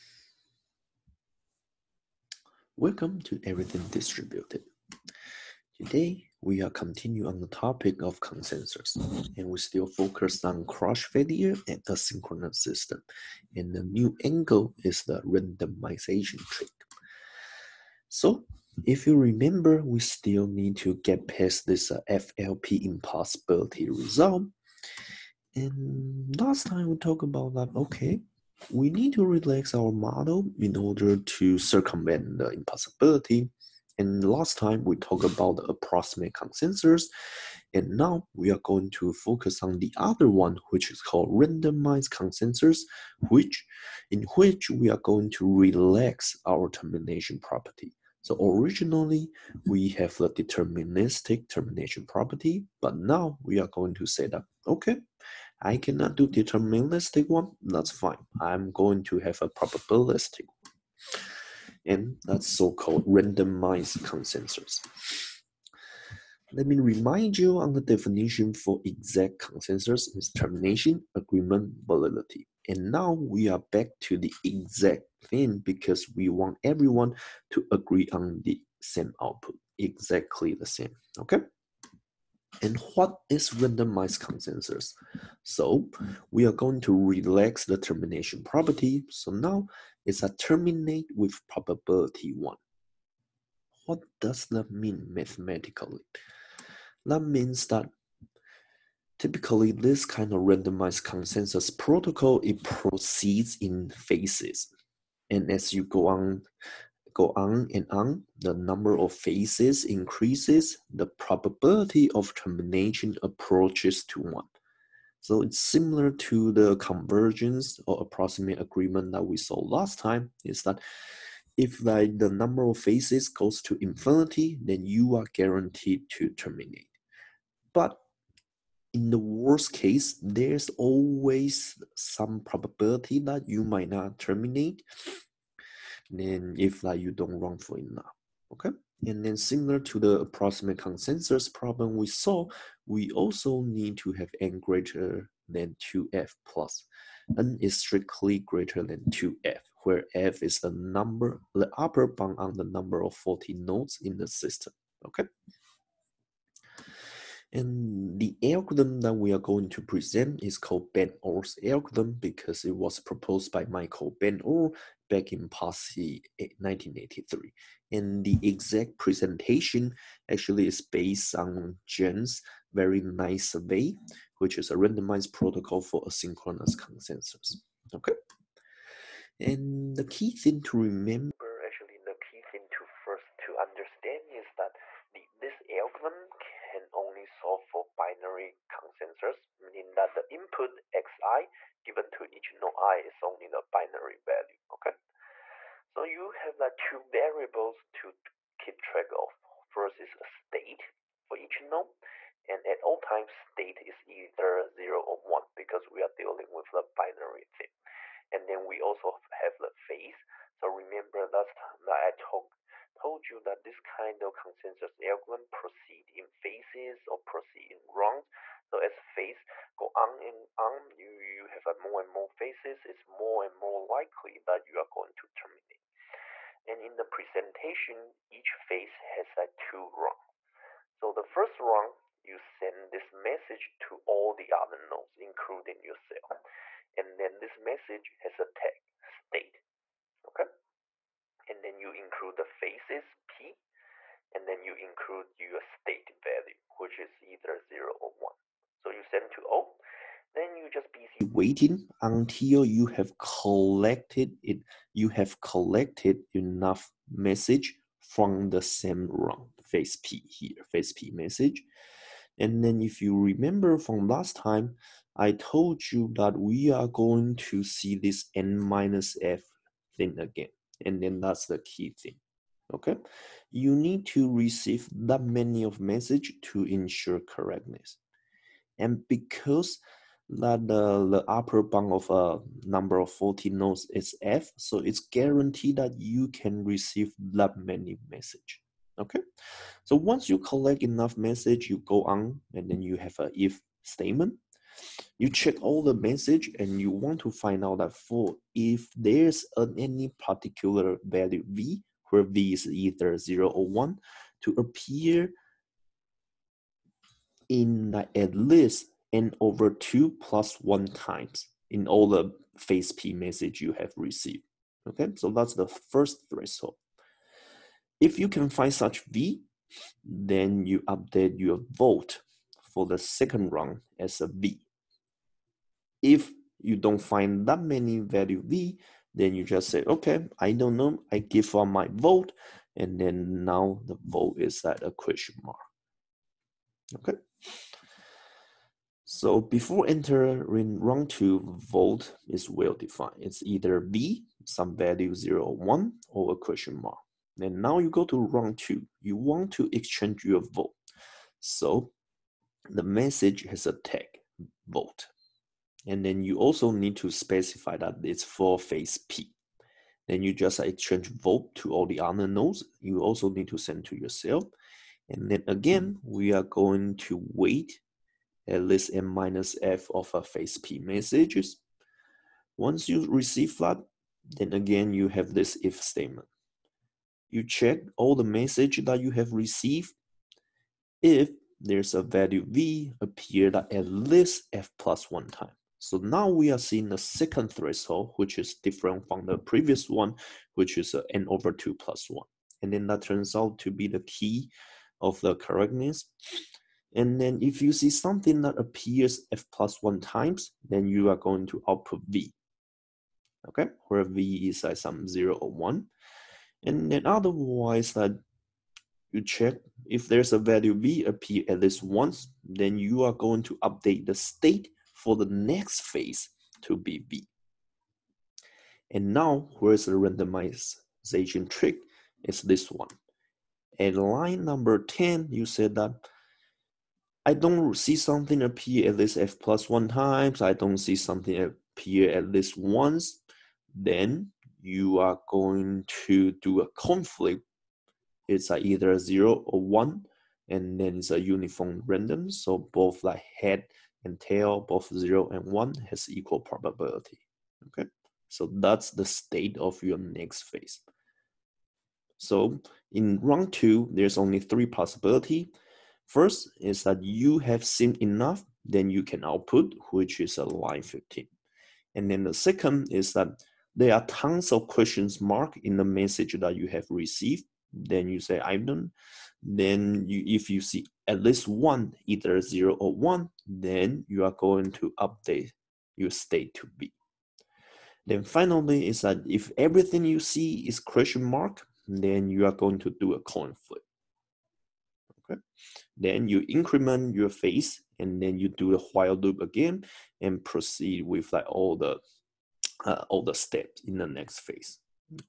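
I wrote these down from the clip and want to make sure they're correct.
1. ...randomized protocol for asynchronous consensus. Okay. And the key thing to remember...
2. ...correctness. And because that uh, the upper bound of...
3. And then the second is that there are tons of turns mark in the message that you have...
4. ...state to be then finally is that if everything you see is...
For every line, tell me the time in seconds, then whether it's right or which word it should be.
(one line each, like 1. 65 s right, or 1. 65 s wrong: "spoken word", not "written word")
1. 174 s right
2. 277 s right
3. 461 s wrong: "questions", not "turns"
4. 476 s right.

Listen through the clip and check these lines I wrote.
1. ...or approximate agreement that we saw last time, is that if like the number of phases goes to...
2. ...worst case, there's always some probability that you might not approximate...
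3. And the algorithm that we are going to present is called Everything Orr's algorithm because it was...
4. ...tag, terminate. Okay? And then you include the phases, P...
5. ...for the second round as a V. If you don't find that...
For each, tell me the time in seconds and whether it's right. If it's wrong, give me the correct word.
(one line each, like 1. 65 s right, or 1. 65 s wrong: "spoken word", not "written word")
1. 117 s right
2. 129 s wrong: "terminate", not "approximate"
3. 157 s wrong: "Ben", not "Everything"
4. 238 s wrong: "state", not "terminate"
5. 322 s right.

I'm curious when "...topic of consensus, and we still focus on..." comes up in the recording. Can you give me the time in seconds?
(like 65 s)
7 s.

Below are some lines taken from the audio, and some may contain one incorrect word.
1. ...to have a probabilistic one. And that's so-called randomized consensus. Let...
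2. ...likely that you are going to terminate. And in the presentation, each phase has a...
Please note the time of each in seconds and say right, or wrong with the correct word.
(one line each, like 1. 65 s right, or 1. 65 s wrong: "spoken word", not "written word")
1. 59 s right
2. 223 s right.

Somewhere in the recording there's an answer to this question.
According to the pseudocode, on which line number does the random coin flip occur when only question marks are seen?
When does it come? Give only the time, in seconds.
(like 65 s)
423 s.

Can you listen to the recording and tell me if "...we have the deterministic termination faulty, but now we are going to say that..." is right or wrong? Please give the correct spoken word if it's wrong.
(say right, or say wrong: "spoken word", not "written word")
wrong: "property", not "faulty".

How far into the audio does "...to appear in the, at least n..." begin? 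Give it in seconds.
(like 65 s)
304 s.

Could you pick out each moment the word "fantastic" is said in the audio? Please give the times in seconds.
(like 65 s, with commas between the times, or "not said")
not said.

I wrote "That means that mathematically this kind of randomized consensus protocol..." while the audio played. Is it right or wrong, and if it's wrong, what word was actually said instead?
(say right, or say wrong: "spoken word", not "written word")
wrong: "typically", not "mathematically".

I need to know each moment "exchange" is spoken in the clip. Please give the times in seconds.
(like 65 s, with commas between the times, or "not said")
349 s, 360 s.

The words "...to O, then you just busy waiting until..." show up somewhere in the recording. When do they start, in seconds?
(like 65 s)
249 s.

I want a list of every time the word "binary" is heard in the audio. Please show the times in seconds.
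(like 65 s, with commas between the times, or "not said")
187 s, 193 s, 206 s.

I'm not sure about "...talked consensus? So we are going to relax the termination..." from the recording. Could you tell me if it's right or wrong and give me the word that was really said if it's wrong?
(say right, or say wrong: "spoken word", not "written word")
wrong: "randomized", not "talked".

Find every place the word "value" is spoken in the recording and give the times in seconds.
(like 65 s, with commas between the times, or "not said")
194 s, 246 s, 301 s, 327 s, 344 s, 382 s, 410 s.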